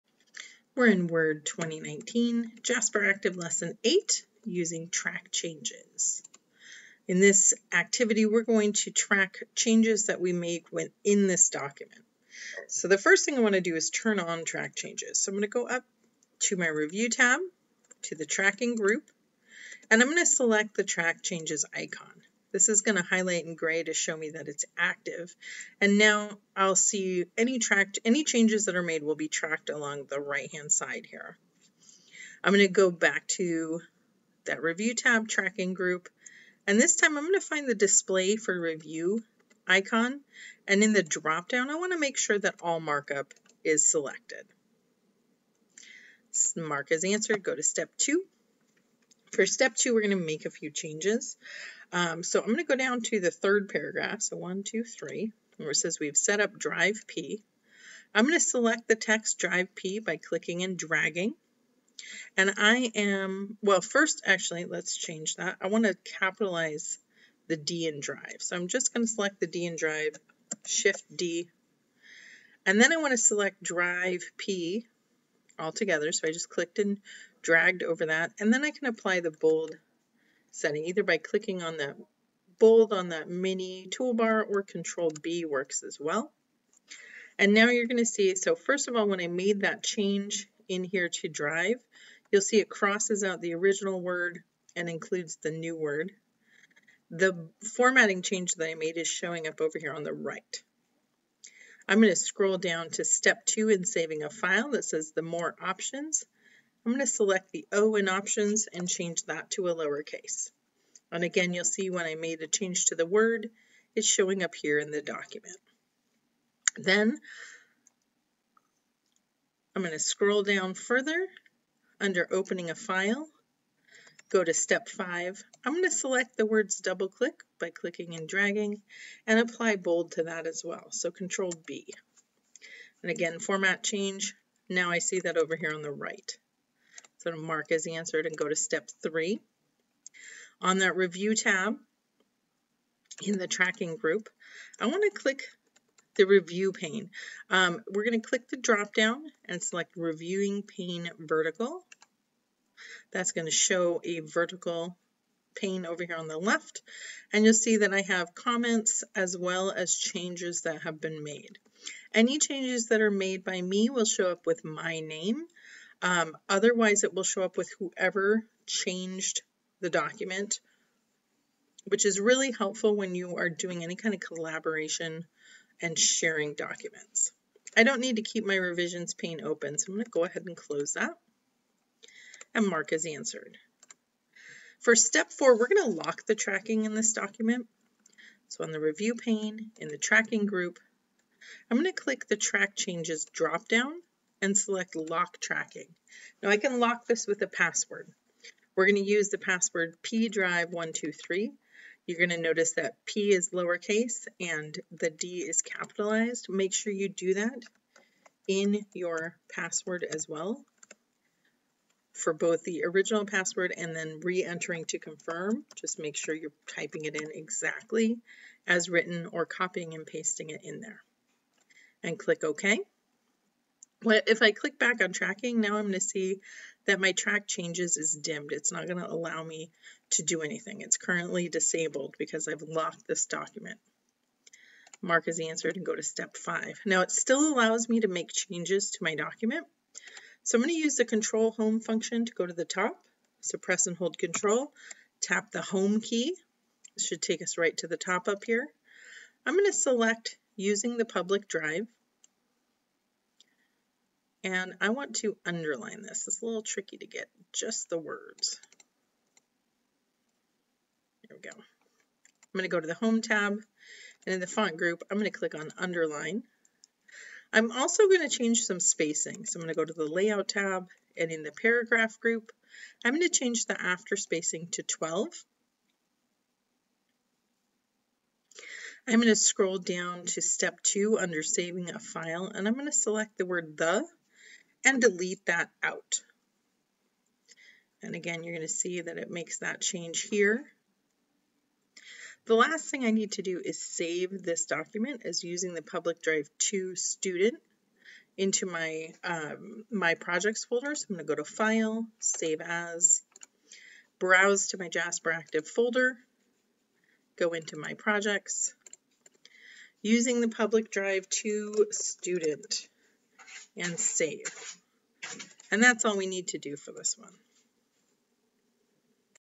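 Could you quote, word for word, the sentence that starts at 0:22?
This is going to highlight in gray to show me that it's active.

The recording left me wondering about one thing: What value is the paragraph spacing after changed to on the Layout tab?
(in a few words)
12.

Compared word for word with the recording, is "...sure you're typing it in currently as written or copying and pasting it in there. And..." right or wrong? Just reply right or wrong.
wrong.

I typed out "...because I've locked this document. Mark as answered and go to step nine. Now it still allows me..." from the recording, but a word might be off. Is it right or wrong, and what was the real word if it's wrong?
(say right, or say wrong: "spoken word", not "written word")
wrong: "five", not "nine".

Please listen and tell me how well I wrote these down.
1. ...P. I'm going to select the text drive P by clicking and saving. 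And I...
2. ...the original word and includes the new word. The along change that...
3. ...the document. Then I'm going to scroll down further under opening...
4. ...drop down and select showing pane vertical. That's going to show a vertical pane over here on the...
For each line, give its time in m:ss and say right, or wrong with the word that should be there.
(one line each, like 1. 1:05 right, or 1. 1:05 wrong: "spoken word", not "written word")
1. 0:57 wrong: "dragging", not "saving"
2. 1:33 wrong: "formatting", not "along"
3. 1:54 right
4. 2:28 wrong: "reviewing", not "showing".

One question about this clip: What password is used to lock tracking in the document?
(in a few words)
pdrive123.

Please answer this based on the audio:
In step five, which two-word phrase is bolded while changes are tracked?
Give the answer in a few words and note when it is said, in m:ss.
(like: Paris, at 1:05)
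double click, at 2:06.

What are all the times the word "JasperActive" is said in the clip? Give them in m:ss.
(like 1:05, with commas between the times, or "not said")
0:02, 5:04.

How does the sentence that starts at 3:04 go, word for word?
For step four, we're going to lock the tracking in this document.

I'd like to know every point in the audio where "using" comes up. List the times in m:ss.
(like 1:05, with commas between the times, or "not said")
0:04, 4:10, 4:55, 5:10.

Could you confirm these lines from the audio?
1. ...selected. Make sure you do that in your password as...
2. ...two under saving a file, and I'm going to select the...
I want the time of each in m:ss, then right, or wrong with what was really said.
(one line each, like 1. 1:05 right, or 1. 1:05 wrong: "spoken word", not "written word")
1. 3:25 wrong: "capitalized", not "selected"
2. 4:40 right.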